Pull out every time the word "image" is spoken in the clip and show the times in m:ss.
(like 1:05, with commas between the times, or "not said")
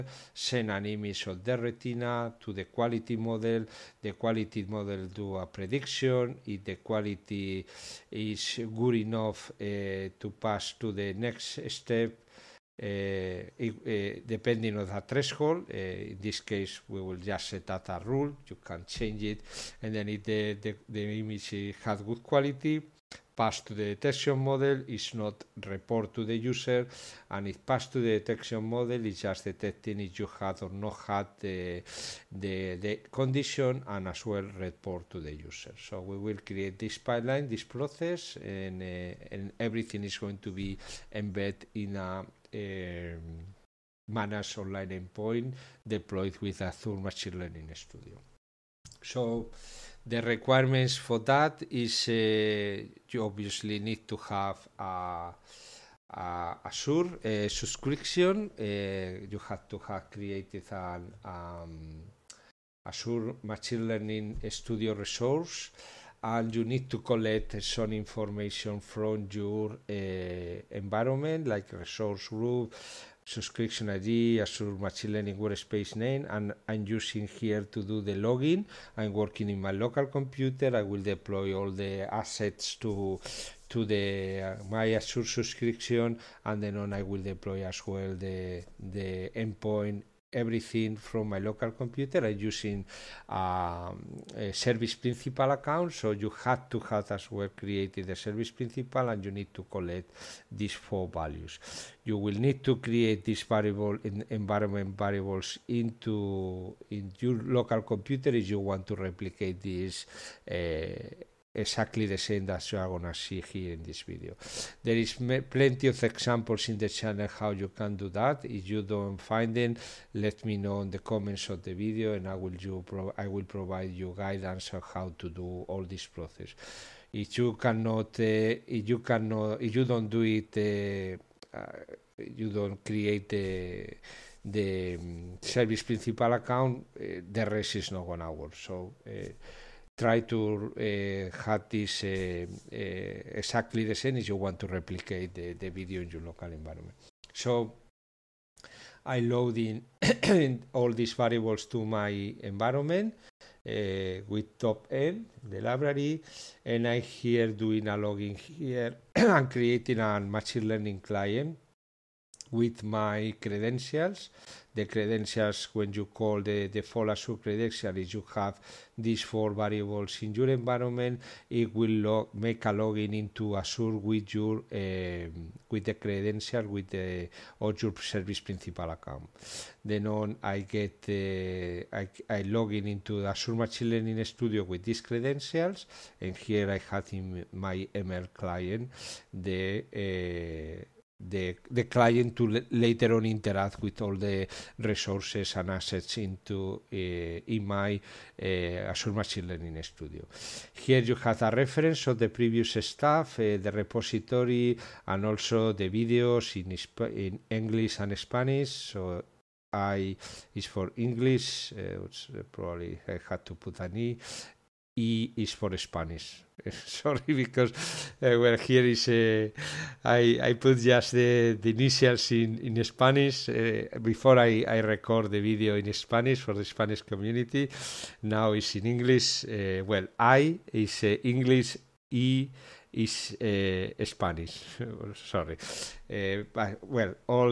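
0:00, 0:21.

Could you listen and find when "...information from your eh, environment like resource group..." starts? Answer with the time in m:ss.
1:07.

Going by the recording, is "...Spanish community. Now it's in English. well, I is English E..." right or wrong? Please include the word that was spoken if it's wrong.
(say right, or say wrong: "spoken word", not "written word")
right.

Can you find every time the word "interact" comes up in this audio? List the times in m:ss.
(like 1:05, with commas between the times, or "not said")
3:13.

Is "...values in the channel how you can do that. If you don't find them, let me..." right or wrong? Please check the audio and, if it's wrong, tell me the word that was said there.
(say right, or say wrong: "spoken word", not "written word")
wrong: "examples", not "values".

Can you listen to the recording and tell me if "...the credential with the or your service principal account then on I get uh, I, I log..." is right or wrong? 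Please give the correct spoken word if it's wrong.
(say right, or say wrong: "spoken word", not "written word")
right.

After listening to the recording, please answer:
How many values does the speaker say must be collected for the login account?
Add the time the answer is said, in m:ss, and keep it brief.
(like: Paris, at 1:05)
4, at 1:40.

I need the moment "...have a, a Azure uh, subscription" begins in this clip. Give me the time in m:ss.
0:54.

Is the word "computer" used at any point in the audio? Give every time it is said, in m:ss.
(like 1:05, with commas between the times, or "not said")
1:20, 1:31, 1:47.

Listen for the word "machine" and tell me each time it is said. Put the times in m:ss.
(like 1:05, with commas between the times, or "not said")
0:46, 1:03, 1:14, 2:40, 3:03, 3:19.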